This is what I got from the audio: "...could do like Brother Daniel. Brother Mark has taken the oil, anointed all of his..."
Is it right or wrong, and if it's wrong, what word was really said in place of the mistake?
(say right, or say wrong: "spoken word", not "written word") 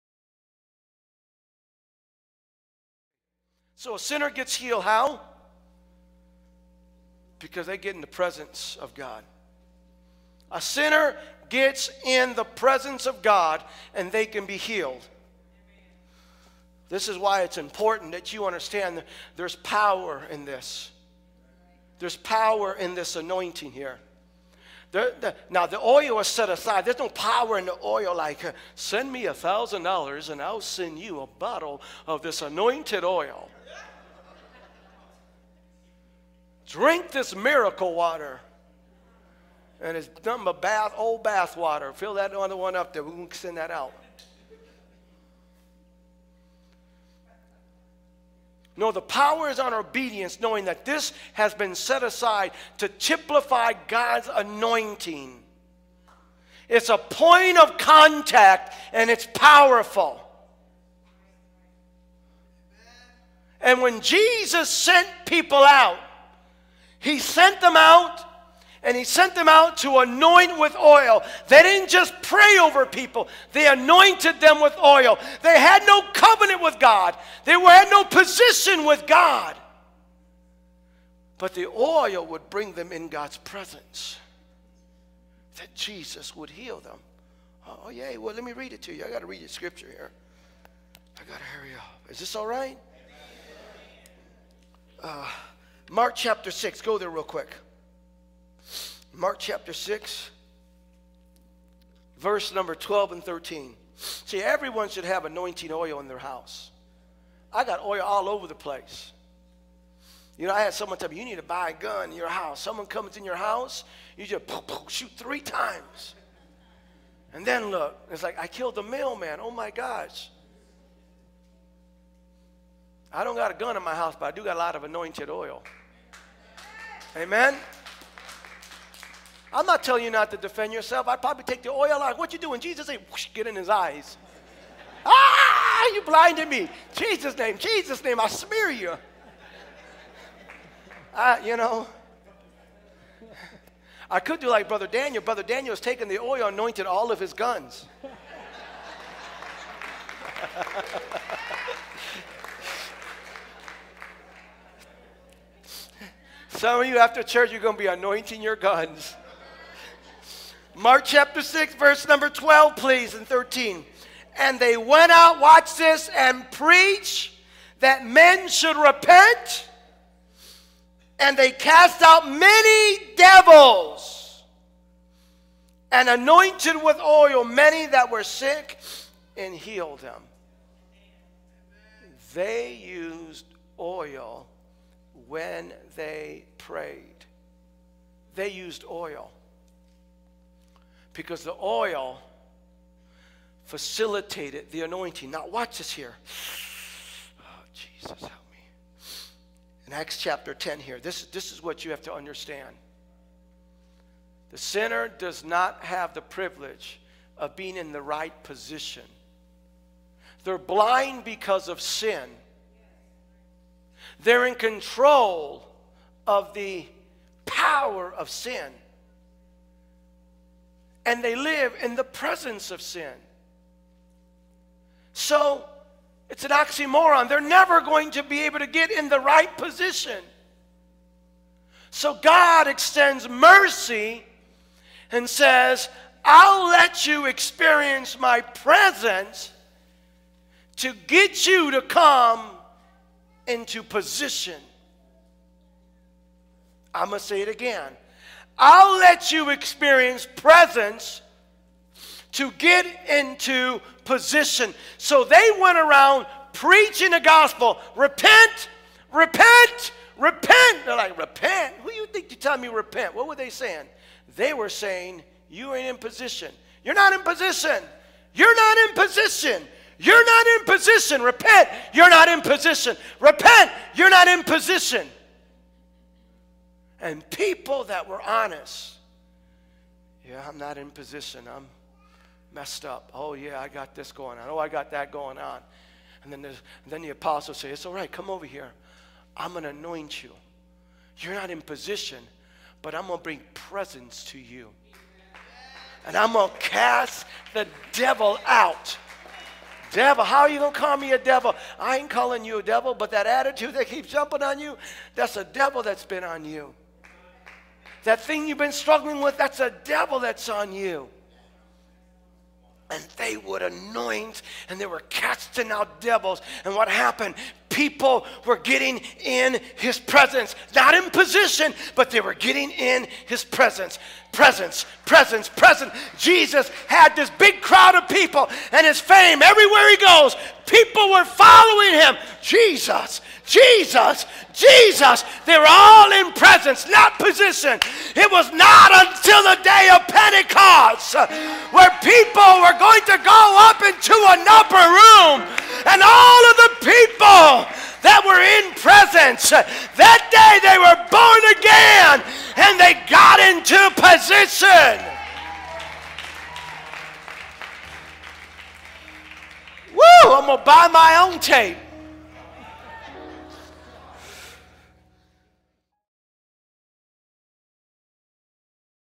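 wrong: "Daniel", not "Mark".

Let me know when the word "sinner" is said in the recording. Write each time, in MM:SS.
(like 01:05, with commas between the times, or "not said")
00:03, 00:10, 03:24.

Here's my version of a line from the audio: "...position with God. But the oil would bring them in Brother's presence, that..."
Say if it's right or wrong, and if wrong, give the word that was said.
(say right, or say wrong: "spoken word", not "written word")
wrong: "God", not "Brother".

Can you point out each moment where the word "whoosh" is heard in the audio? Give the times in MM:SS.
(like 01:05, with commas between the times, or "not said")
02:13.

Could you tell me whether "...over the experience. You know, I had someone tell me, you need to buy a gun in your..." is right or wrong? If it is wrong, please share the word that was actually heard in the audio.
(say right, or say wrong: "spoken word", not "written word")
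wrong: "place", not "experience".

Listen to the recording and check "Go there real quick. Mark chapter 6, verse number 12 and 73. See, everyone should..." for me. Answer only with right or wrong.
wrong.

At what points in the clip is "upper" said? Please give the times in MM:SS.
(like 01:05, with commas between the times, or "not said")
05:44.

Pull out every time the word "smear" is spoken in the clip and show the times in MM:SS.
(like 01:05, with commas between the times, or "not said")
02:18.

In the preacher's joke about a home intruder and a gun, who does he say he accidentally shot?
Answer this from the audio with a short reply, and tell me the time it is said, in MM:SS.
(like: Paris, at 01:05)
the mailman, at 01:58.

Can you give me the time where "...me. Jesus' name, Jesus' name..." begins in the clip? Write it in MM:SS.
02:16.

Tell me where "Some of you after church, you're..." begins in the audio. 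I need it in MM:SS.
02:36.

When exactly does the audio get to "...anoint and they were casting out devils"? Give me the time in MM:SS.
05:13.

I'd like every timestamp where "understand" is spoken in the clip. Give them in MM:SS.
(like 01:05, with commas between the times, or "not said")
00:18, 03:22.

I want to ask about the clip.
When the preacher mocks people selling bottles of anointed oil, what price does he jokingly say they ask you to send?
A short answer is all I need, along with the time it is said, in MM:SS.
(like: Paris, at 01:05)
$1,000, at 00:29.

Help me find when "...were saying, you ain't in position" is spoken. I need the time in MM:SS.
04:24.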